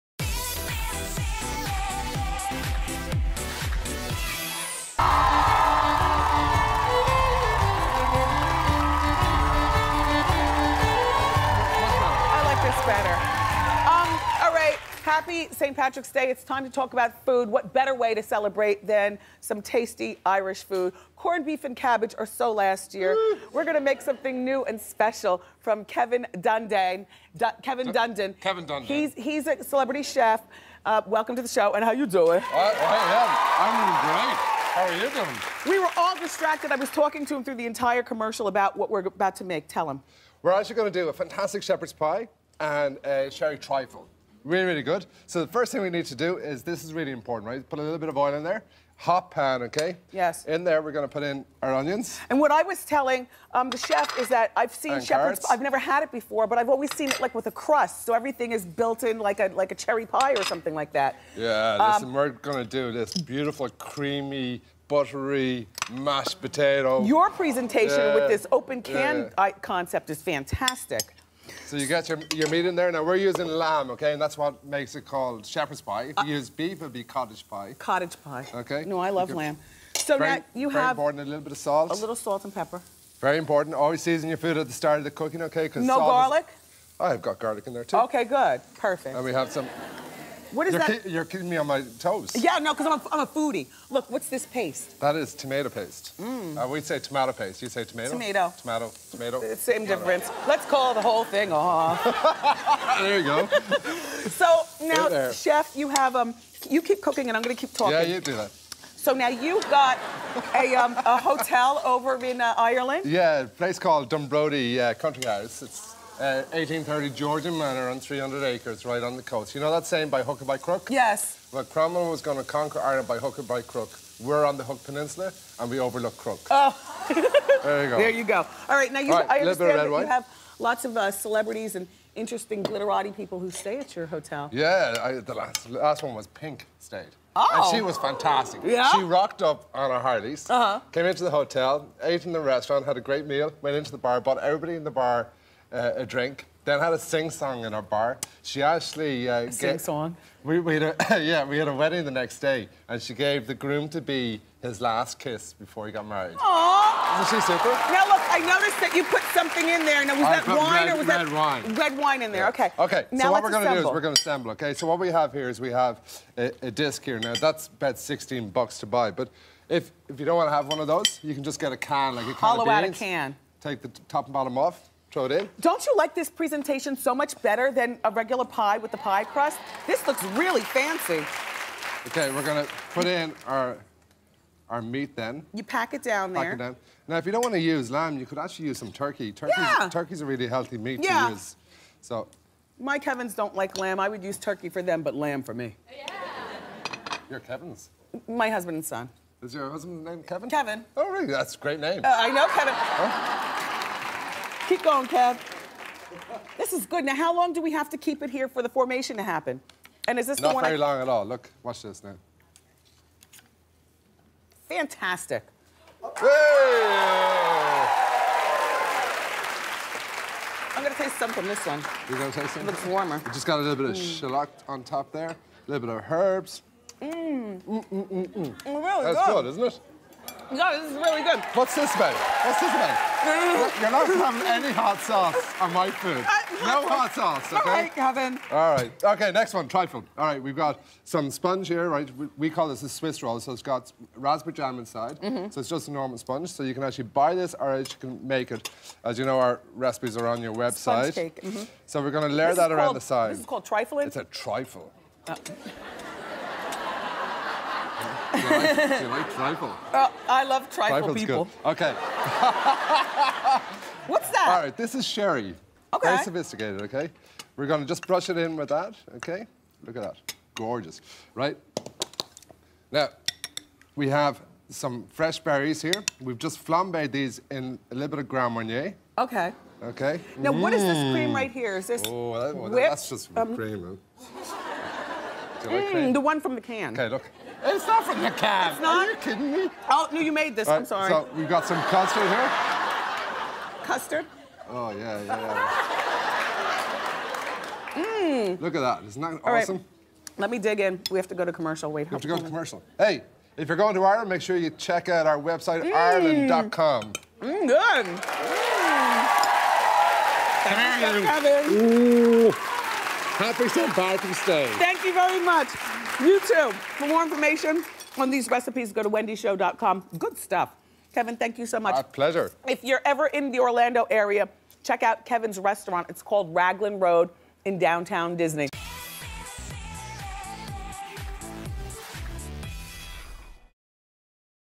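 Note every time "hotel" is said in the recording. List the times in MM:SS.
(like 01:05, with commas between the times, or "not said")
01:51, 02:14, 02:21.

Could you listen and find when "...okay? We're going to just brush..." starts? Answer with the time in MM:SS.
04:26.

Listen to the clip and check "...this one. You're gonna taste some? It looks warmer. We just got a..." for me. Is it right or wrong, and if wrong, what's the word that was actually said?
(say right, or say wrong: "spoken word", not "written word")
right.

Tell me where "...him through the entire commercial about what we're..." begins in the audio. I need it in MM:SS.
00:37.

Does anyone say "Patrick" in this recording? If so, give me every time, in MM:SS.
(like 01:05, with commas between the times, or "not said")
00:15, 05:13.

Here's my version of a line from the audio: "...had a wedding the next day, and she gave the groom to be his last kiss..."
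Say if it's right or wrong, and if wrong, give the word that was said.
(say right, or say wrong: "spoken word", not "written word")
right.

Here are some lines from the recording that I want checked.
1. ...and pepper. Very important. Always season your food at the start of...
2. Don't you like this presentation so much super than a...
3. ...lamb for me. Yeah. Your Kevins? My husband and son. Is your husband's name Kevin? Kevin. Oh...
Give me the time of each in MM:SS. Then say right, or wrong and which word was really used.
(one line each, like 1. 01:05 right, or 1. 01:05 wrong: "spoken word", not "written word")
1. 01:22 right
2. 02:55 wrong: "better", not "super"
3. 03:15 right.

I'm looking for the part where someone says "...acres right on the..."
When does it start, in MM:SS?
01:58.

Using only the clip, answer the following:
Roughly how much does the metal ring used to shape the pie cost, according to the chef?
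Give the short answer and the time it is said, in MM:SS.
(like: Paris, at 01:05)
16 dollars, at 02:47.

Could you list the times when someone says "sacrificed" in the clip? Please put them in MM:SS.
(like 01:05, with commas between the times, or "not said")
not said.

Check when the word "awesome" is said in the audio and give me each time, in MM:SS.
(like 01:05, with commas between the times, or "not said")
04:59.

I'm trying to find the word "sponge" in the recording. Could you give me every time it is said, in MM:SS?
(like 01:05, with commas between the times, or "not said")
04:01, 04:06, 04:11.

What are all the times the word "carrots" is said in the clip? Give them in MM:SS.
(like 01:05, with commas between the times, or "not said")
00:55.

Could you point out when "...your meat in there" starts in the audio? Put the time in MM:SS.
01:12.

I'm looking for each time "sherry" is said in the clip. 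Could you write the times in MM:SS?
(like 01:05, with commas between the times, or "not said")
00:43, 04:25.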